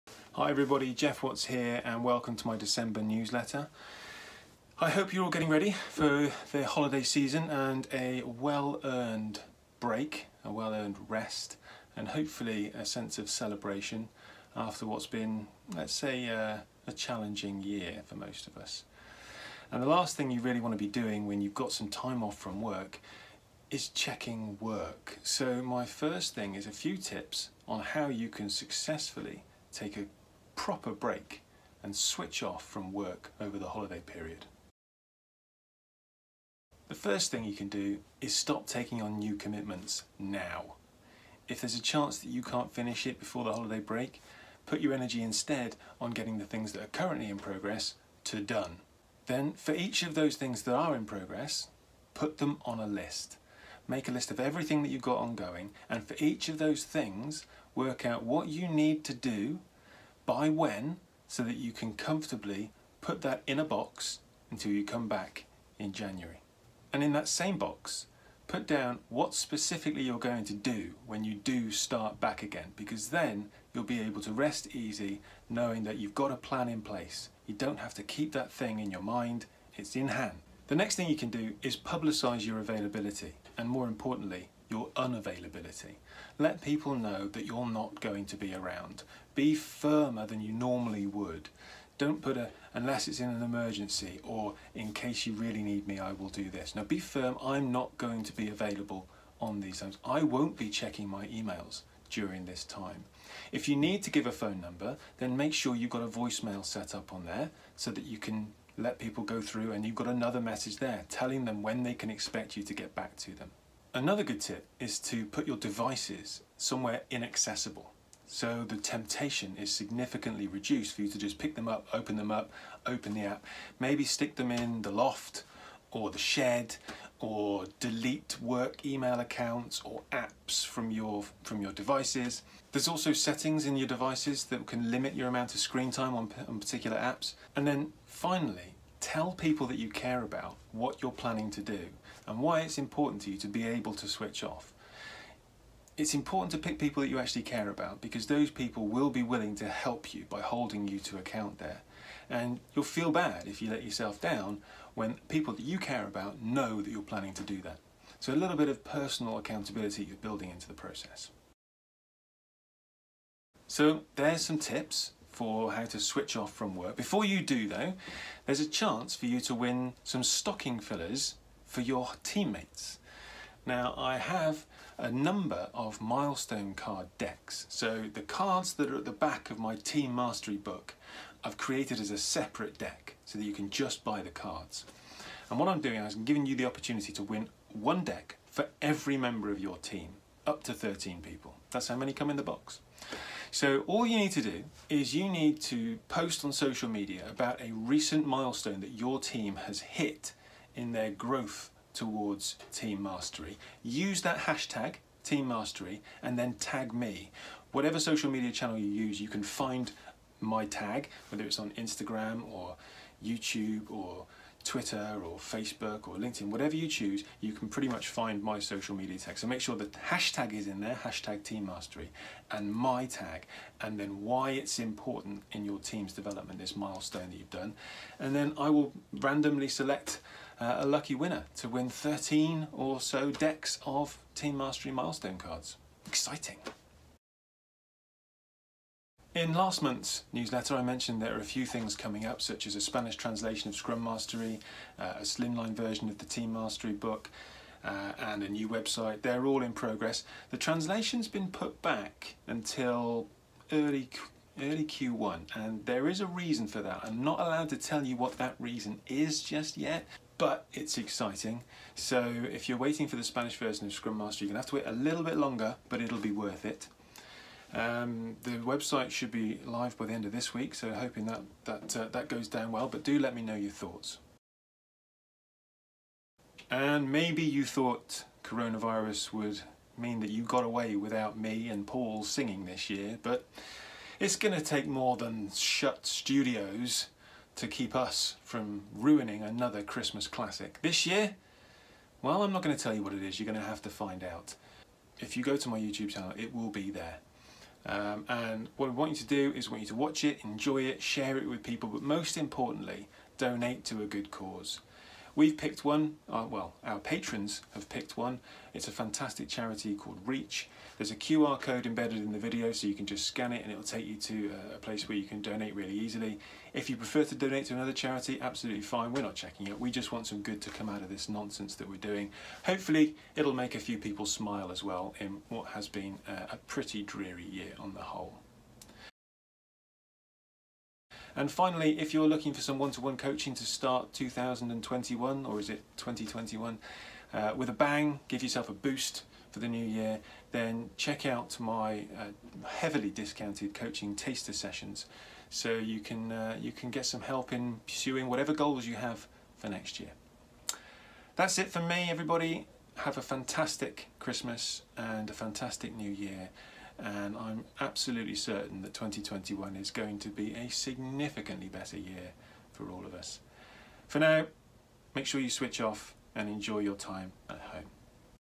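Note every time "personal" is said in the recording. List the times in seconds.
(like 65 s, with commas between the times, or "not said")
158 s.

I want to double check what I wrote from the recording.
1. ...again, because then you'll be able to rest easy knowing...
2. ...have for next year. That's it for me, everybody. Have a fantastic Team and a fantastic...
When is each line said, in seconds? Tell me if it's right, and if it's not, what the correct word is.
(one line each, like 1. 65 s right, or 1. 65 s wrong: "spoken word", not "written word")
1. 72 s right
2. 348 s wrong: "Christmas", not "Team".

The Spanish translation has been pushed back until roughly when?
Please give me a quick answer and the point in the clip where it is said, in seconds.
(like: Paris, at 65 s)
early Q1, at 253 s.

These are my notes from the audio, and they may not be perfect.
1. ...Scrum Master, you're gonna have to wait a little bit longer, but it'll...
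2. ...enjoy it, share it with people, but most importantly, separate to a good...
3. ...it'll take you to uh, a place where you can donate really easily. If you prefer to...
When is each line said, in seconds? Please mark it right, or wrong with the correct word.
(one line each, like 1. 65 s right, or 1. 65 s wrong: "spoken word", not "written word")
1. 263 s right
2. 300 s wrong: "donate", not "separate"
3. 313 s right.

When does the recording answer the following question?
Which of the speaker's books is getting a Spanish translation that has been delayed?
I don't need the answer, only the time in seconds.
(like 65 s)
243 s.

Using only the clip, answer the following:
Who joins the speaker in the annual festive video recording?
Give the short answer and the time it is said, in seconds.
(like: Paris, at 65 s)
Paul, at 281 s.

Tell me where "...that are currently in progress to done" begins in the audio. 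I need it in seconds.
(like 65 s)
46 s.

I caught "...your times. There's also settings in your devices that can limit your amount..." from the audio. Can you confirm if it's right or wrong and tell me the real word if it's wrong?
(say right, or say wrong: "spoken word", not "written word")
wrong: "devices", not "times".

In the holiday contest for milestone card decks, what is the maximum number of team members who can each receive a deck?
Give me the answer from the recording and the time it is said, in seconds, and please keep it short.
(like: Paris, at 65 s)
13, at 190 s.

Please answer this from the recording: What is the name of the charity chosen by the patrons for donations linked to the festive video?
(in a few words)
Reach.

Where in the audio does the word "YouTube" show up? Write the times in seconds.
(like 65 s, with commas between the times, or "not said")
213 s, 295 s.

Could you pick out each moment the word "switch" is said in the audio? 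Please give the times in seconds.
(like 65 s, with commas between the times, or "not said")
31 s, 144 s, 165 s, 365 s.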